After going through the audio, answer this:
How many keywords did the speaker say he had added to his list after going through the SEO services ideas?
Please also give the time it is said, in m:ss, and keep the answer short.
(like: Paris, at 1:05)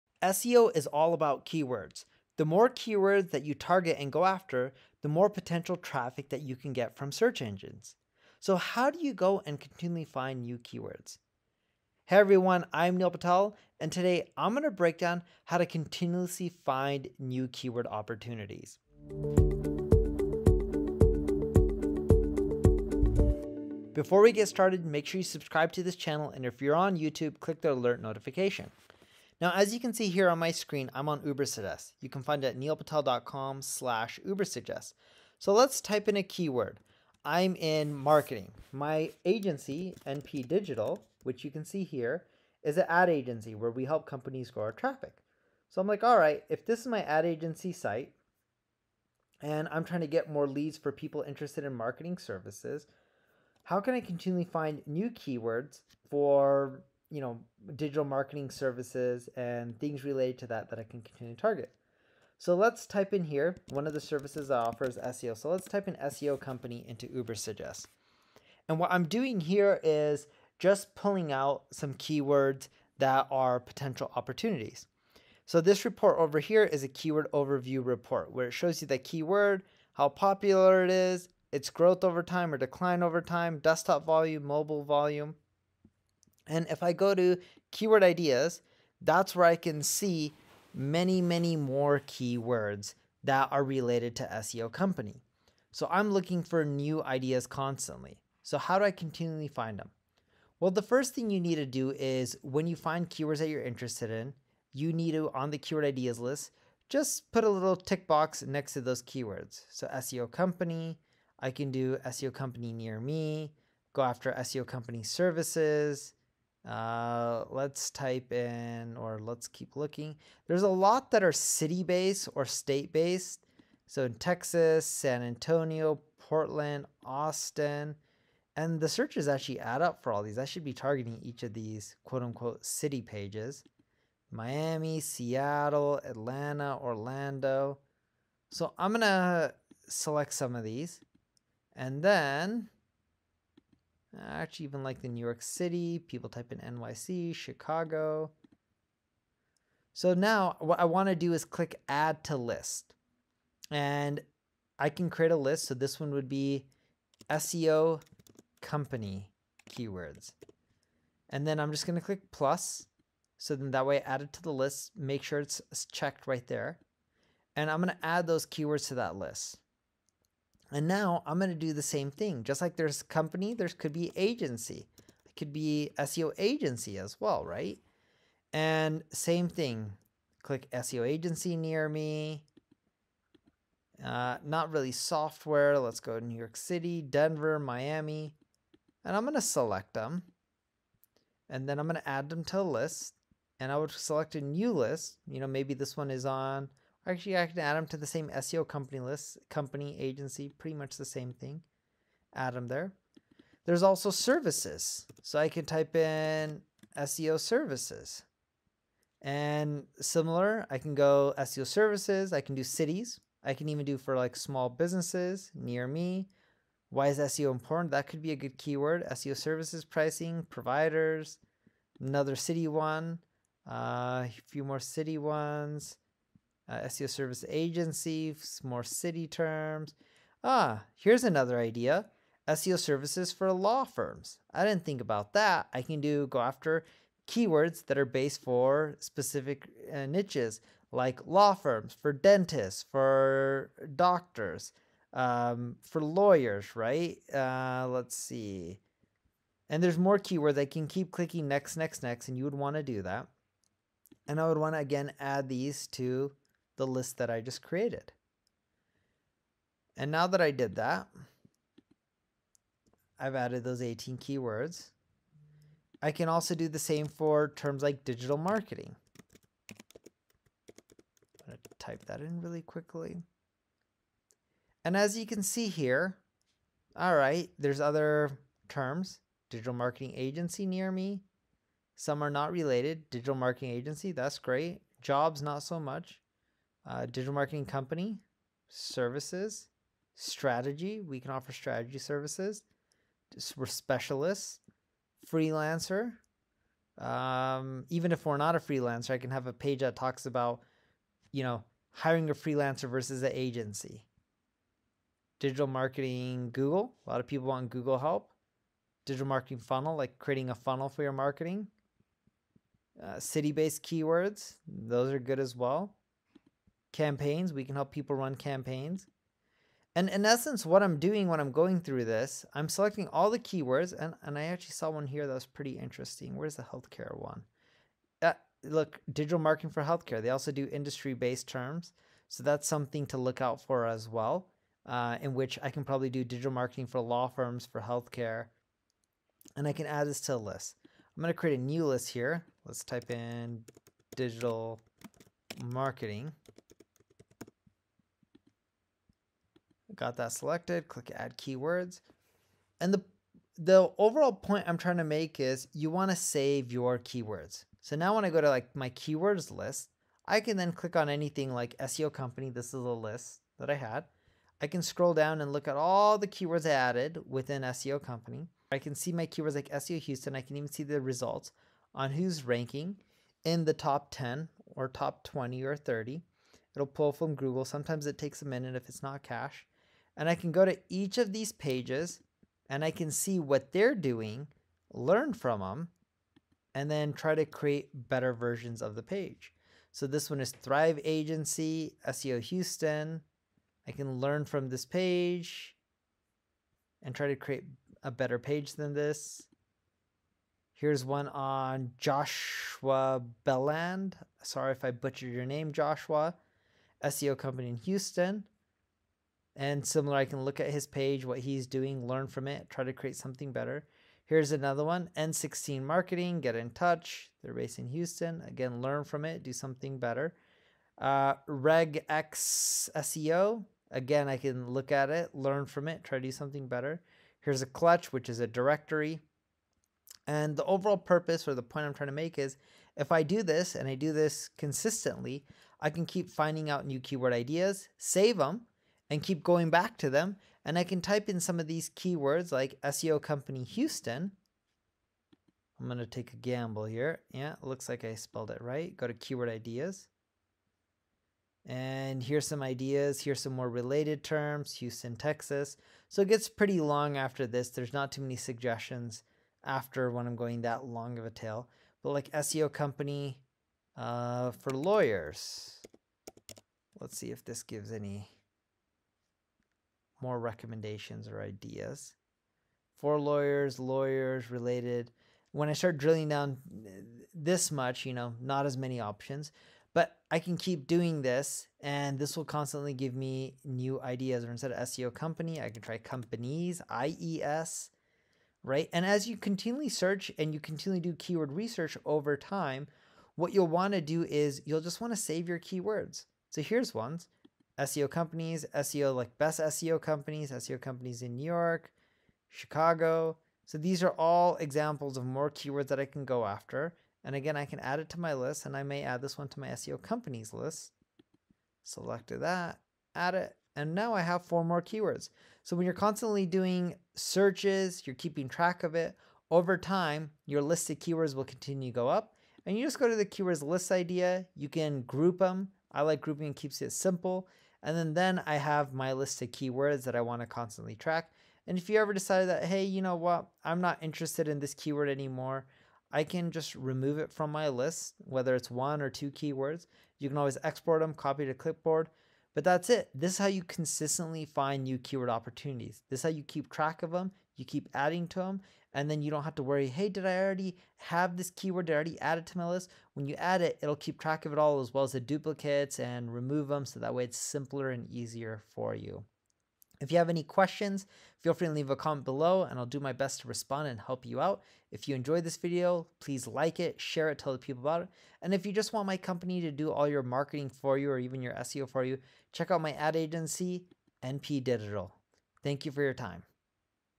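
18, at 4:23.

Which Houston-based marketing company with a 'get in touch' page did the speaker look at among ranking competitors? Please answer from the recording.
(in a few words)
N16 Marketing.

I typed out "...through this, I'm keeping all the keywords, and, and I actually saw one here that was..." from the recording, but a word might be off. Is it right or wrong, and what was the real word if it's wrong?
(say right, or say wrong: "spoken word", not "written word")
wrong: "selecting", not "keeping".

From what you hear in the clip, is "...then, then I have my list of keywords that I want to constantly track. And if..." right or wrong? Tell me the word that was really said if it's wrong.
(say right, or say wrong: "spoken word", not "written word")
right.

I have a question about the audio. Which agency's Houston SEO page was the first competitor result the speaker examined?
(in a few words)
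Thrive Agency.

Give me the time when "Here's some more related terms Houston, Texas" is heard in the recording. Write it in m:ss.
7:33.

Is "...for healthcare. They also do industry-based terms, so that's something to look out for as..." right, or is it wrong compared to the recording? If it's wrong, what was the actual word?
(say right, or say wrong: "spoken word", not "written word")
right.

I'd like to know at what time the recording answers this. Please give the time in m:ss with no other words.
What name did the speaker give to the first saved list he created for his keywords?
2:37.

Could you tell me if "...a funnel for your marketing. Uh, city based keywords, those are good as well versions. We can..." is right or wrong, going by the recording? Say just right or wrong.
wrong.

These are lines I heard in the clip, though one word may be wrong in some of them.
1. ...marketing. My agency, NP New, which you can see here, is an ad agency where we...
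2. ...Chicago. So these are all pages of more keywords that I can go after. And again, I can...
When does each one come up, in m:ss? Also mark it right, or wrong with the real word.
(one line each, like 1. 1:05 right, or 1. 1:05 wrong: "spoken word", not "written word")
1. 0:37 wrong: "Digital", not "New"
2. 8:22 wrong: "examples", not "pages".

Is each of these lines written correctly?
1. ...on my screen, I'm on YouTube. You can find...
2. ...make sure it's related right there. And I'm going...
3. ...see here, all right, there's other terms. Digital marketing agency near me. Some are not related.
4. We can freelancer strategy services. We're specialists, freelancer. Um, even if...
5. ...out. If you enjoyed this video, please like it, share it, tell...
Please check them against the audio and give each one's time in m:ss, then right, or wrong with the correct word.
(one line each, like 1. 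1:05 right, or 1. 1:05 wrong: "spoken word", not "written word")
1. 0:30 wrong: "Ubersuggest", not "YouTube"
2. 2:44 wrong: "checked", not "related"
3. 4:35 right
4. 4:51 wrong: "offer", not "freelancer"
5. 9:24 right.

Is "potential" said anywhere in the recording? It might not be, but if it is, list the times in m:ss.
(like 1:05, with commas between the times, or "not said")
0:05, 1:13.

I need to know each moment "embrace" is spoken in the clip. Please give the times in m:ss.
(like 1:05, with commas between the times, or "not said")
not said.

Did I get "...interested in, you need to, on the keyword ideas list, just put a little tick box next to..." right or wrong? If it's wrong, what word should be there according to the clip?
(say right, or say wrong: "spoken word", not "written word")
right.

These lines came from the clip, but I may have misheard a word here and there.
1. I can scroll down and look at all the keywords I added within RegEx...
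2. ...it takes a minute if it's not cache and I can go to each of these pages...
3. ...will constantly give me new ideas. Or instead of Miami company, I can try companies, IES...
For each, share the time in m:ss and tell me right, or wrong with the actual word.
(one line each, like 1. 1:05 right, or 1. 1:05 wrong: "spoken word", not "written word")
1. 6:04 wrong: "SEO", not "RegEx"
2. 6:18 right
3. 8:02 wrong: "SEO", not "Miami".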